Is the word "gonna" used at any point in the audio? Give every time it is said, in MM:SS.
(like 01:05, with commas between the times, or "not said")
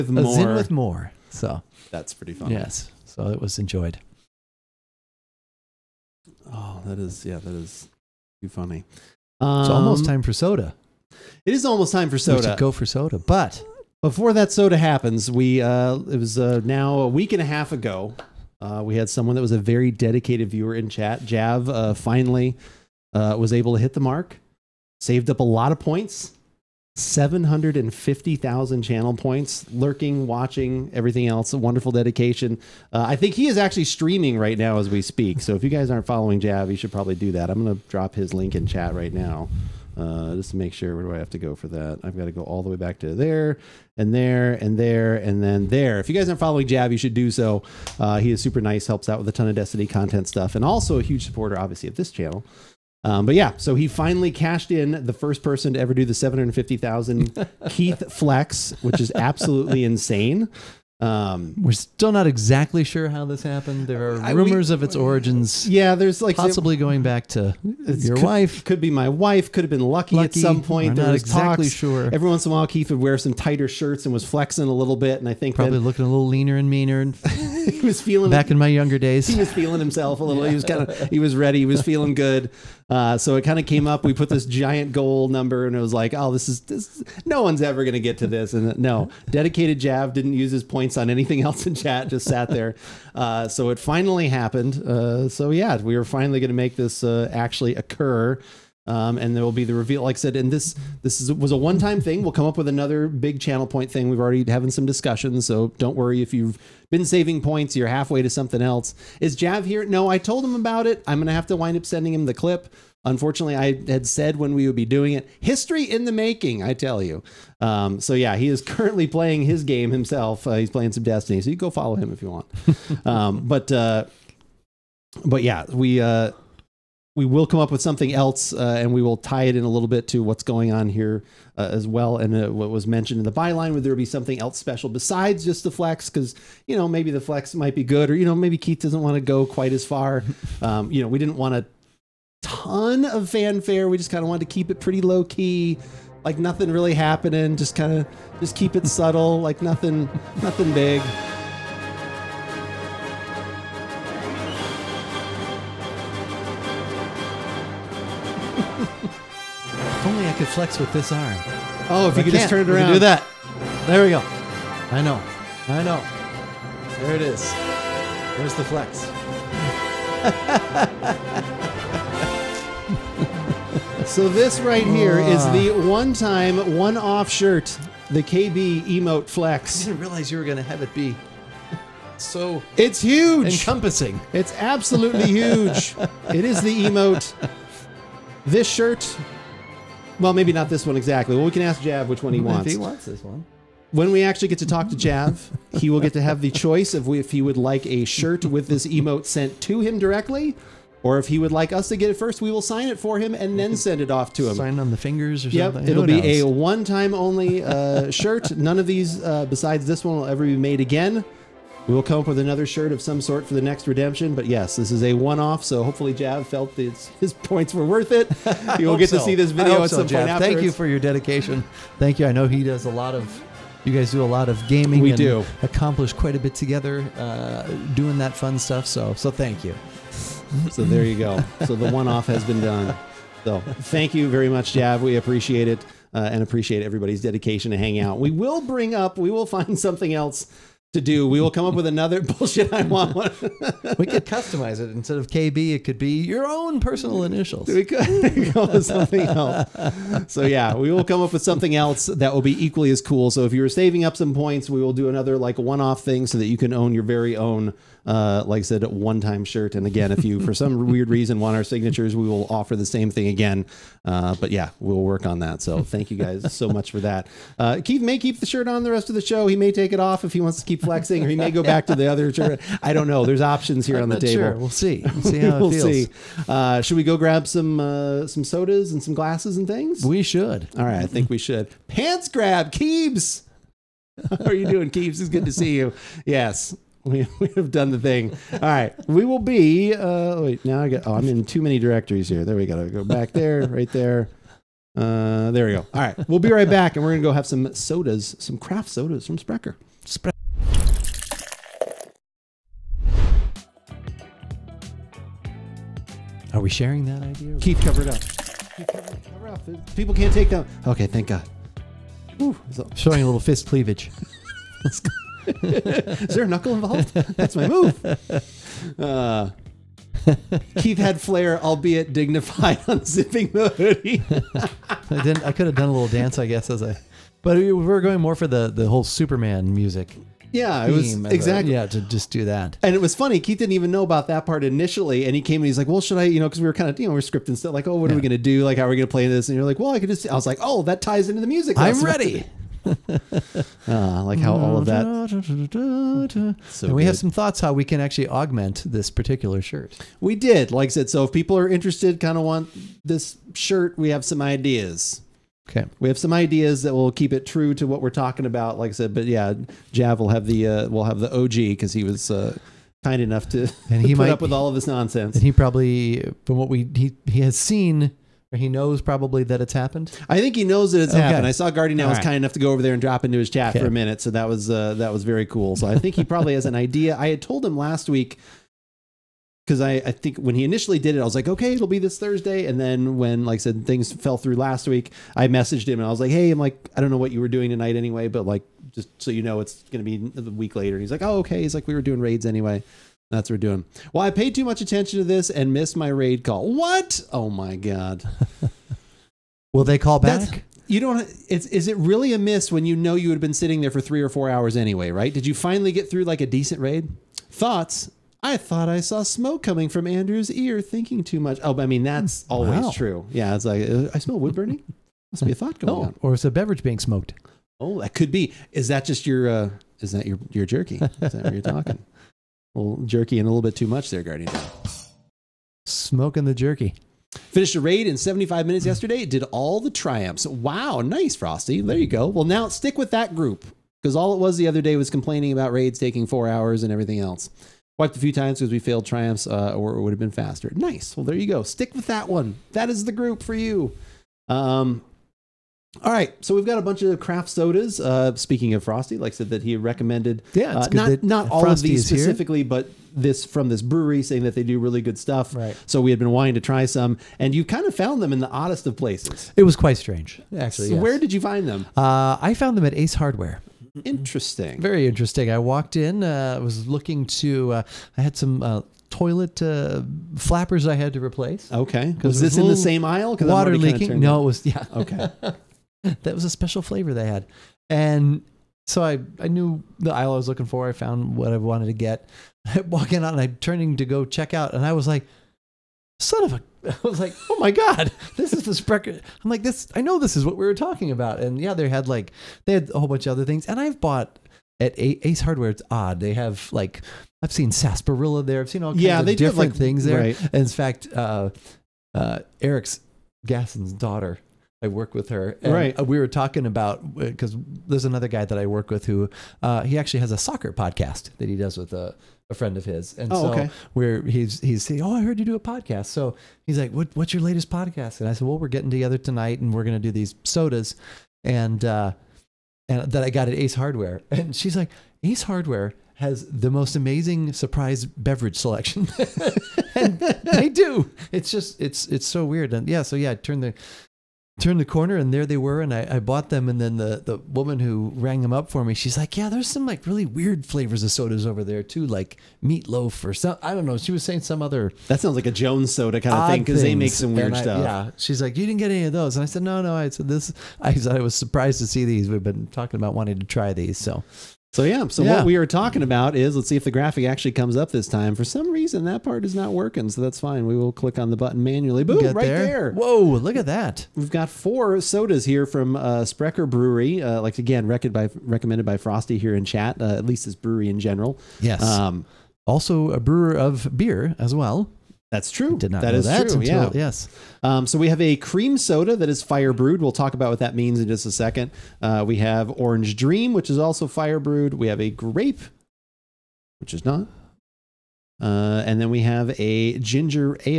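01:51, 04:57.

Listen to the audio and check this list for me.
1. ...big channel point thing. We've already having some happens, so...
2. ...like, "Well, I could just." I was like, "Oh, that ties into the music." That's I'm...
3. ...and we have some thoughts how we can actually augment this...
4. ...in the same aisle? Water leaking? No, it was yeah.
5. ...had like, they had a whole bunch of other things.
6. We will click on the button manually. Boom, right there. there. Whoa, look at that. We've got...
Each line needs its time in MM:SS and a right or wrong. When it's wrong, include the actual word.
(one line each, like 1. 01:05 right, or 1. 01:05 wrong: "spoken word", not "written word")
1. 01:43 wrong: "discussions", not "happens"
2. 05:39 right
3. 05:46 right
4. 07:52 right
5. 08:11 right
6. 09:20 right.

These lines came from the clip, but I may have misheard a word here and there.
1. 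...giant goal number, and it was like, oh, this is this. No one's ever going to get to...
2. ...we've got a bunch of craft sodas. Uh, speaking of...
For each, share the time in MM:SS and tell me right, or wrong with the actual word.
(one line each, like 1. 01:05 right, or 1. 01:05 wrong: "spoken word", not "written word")
1. 01:24 right
2. 07:26 right.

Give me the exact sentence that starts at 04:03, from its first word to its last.
we could customize it instead of KB.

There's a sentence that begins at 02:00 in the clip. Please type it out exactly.
Uh, he's playing some Destiny, so you go follow him if you want.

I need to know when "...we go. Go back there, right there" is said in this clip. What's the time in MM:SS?
04:52.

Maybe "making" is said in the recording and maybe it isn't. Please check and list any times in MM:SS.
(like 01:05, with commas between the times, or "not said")
01:56.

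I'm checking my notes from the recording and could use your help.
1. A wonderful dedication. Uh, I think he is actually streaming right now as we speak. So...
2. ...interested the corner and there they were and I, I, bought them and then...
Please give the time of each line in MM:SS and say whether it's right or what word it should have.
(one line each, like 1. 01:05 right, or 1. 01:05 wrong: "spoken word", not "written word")
1. 00:31 right
2. 08:54 wrong: "turned", not "interested".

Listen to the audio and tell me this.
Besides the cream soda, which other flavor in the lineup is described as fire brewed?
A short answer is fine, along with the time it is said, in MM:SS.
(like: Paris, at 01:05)
Orange Dream, at 09:42.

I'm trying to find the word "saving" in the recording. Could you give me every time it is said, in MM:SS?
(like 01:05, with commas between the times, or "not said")
01:47, 04:13.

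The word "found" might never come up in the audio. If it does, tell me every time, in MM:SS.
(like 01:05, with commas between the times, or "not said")
07:37, 07:42, 08:00.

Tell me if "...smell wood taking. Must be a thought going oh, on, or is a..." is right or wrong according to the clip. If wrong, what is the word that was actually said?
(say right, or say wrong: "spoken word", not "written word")
wrong: "burning", not "taking".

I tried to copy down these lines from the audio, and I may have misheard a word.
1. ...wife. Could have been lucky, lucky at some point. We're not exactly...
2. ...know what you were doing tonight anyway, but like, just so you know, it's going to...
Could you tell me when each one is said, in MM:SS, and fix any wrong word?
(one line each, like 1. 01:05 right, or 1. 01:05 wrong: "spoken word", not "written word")
1. 01:09 right
2. 06:27 right.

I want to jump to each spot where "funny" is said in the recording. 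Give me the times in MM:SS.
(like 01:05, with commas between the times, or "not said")
00:08, 05:33.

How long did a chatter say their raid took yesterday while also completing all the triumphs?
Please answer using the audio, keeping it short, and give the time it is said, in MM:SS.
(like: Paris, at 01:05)
75 minutes, at 07:08.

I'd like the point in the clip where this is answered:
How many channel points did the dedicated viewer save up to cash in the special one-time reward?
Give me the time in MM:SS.
00:26.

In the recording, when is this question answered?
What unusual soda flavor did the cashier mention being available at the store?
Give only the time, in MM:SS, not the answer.
09:02.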